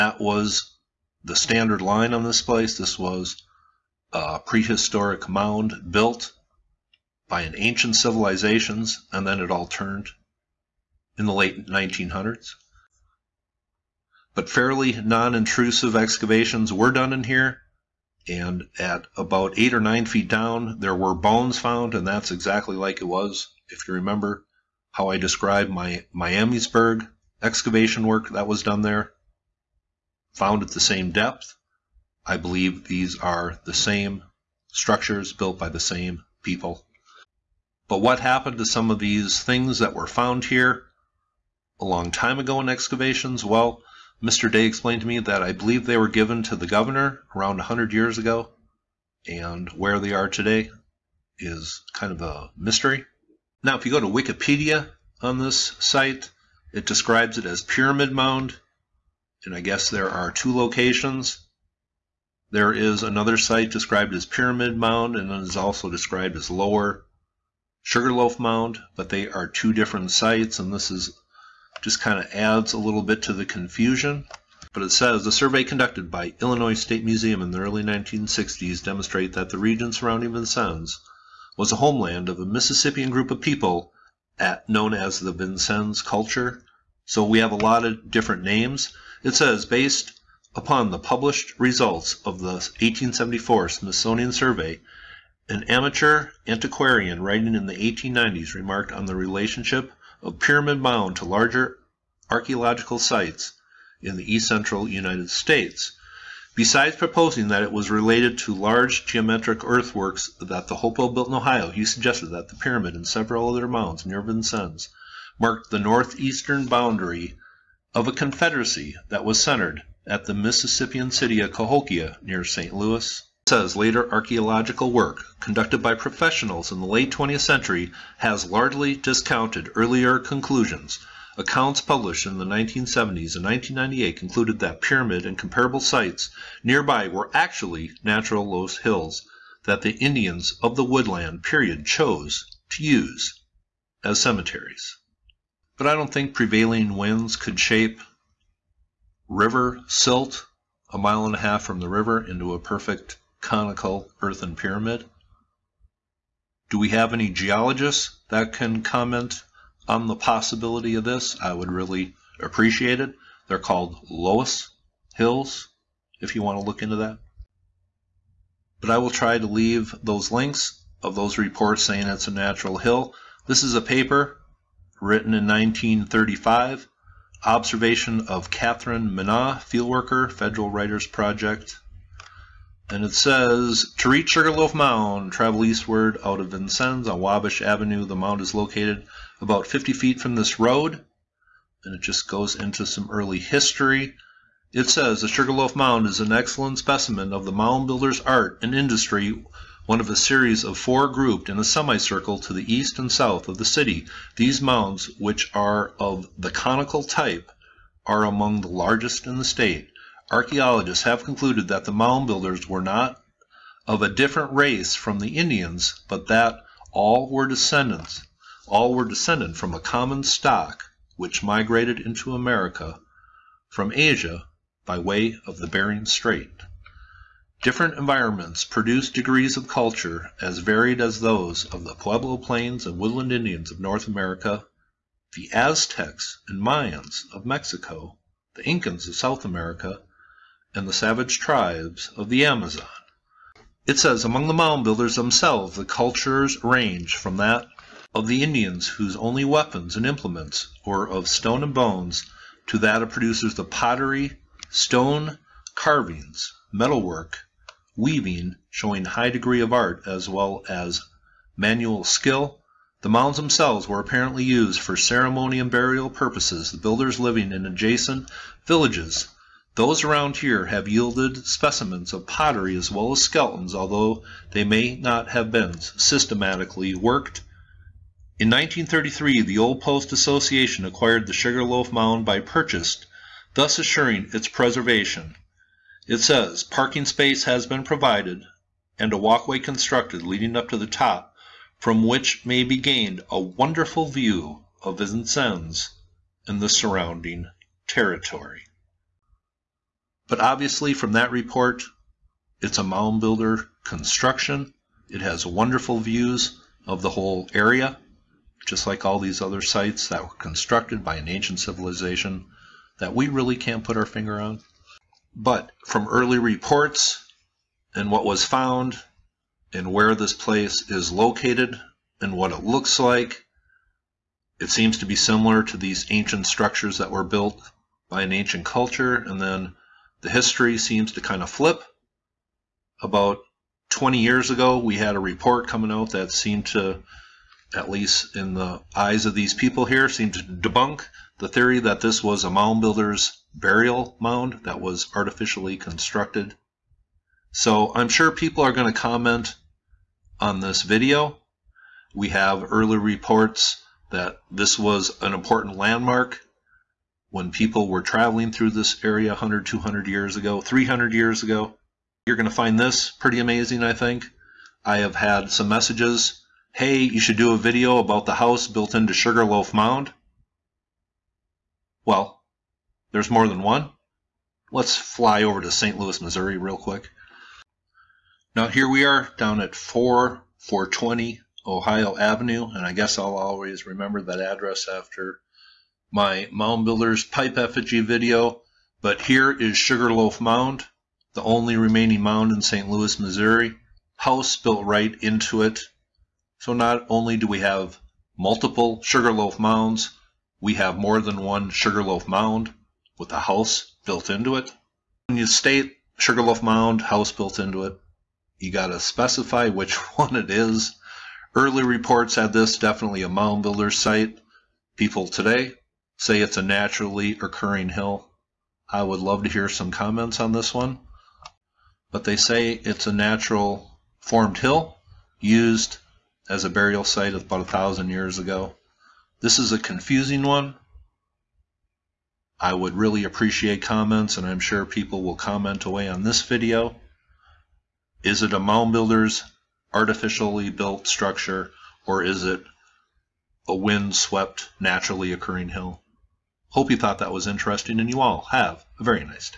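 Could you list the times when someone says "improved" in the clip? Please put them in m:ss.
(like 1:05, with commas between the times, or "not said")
not said.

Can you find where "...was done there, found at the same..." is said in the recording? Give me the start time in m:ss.
0:28.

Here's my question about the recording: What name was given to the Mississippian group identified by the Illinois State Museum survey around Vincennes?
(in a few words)
Vincennes culture.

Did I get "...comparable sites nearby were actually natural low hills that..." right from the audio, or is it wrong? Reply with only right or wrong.
right.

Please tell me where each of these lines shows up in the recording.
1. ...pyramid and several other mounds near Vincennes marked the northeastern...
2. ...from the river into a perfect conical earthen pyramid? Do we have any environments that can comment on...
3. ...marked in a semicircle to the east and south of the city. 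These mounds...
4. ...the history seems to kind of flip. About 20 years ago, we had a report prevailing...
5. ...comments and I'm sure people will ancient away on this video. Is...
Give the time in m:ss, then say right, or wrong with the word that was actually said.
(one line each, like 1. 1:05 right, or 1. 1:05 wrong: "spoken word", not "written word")
1. 1:52 right
2. 2:31 wrong: "geologists", not "environments"
3. 3:21 wrong: "grouped", not "marked"
4. 5:30 wrong: "coming", not "prevailing"
5. 7:13 wrong: "comment", not "ancient".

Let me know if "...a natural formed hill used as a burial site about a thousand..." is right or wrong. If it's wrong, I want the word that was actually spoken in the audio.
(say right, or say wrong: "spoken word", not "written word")
right.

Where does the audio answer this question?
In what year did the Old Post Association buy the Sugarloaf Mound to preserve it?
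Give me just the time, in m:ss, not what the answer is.
4:38.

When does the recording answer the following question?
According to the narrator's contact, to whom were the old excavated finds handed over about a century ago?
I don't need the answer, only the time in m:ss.
0:46.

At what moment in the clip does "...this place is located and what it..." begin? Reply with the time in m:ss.
5:20.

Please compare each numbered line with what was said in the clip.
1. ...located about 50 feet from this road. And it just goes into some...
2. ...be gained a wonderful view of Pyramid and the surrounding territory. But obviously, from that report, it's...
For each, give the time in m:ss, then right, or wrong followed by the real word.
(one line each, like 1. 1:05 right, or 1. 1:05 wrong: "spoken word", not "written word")
1. 3:08 right
2. 4:52 wrong: "Vincennes", not "Pyramid".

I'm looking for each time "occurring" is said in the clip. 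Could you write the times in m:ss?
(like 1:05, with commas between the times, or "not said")
6:57, 7:25.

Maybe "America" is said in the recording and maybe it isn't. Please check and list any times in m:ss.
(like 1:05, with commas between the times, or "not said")
3:42, 3:54, 3:59.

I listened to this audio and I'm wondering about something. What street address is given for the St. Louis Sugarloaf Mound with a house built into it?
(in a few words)
4420 Ohio Avenue.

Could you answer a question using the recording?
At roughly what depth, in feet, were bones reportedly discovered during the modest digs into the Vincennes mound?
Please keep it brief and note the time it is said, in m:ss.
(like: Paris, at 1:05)
8 or 9 feet, at 0:19.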